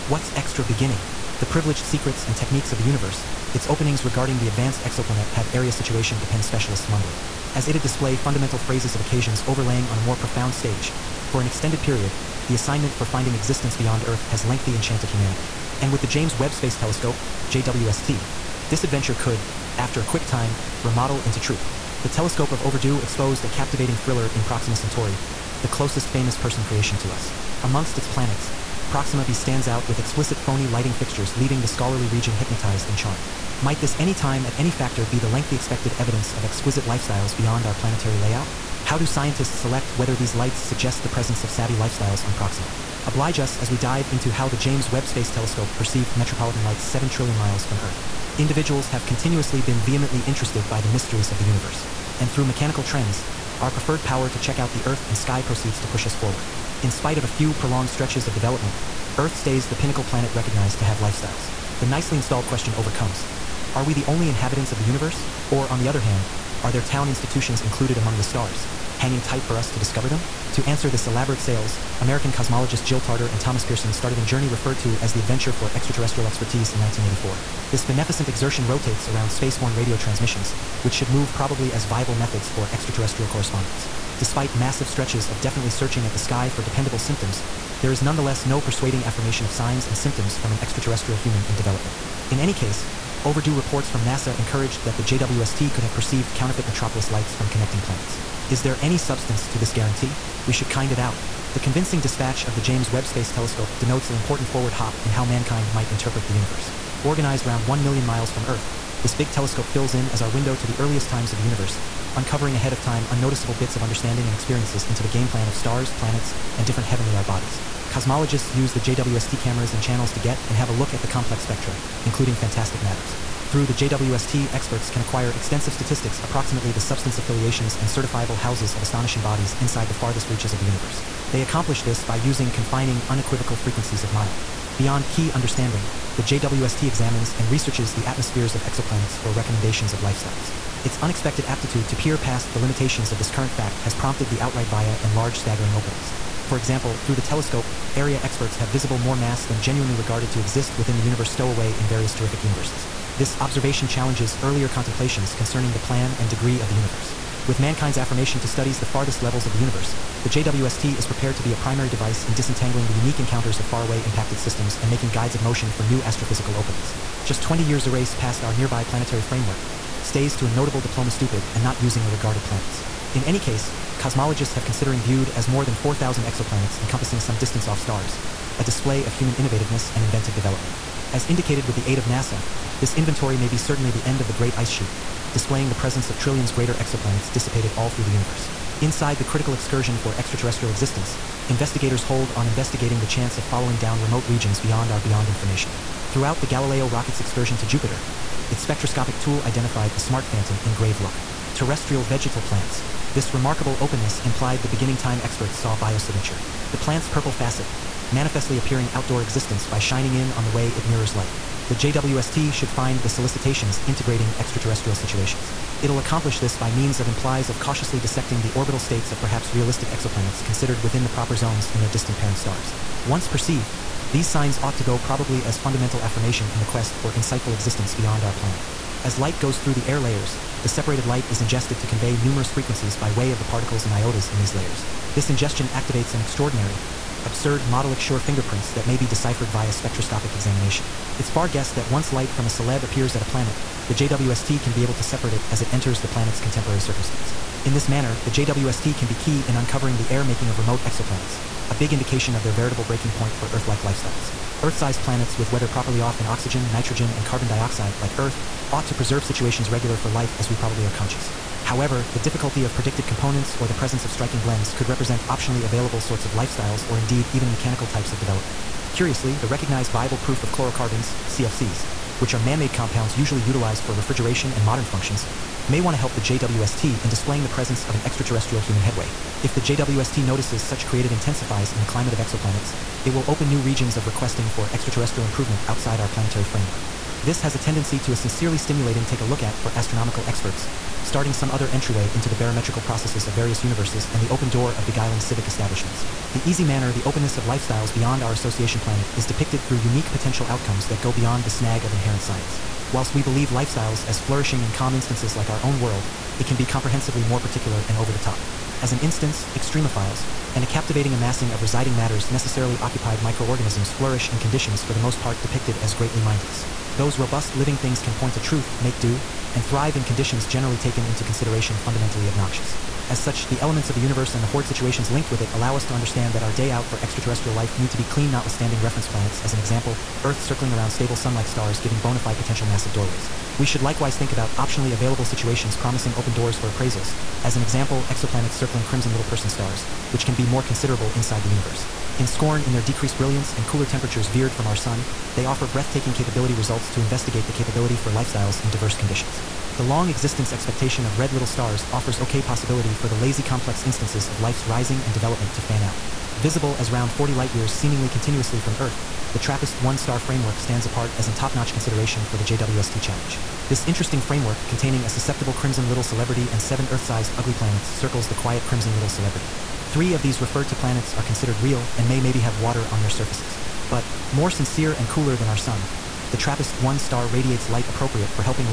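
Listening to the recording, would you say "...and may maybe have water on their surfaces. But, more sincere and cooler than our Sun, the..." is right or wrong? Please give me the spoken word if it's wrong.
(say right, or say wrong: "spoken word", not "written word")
right.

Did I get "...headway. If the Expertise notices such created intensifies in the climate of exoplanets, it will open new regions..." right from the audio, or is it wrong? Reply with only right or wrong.
wrong.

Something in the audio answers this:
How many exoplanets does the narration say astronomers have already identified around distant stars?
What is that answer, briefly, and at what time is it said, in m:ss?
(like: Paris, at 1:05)
4,000, at 2:55.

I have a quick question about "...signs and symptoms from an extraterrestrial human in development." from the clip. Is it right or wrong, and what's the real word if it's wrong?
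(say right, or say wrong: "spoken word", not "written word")
right.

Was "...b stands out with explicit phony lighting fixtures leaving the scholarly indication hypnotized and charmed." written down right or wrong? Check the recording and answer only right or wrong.
wrong.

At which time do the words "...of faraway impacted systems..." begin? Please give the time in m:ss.
2:43.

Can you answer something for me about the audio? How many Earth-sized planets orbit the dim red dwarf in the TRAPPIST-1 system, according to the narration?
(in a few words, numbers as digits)
7.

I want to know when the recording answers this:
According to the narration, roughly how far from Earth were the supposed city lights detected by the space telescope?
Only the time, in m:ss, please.
0:46.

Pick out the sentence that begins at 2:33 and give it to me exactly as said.
This observation challenges earlier contemplations concerning the plan and degree of the universe.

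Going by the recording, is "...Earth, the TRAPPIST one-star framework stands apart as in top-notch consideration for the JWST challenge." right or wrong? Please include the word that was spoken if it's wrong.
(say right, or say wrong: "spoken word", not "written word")
right.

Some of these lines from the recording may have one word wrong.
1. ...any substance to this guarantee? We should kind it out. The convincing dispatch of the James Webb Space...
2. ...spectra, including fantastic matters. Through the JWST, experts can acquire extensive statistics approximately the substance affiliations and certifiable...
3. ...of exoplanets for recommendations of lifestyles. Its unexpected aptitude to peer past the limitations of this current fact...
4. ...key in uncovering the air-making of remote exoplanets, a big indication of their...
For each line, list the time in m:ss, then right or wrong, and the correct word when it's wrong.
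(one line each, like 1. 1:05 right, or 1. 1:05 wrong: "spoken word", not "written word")
1. 1:38 right
2. 2:01 right
3. 2:18 right
4. 4:09 right.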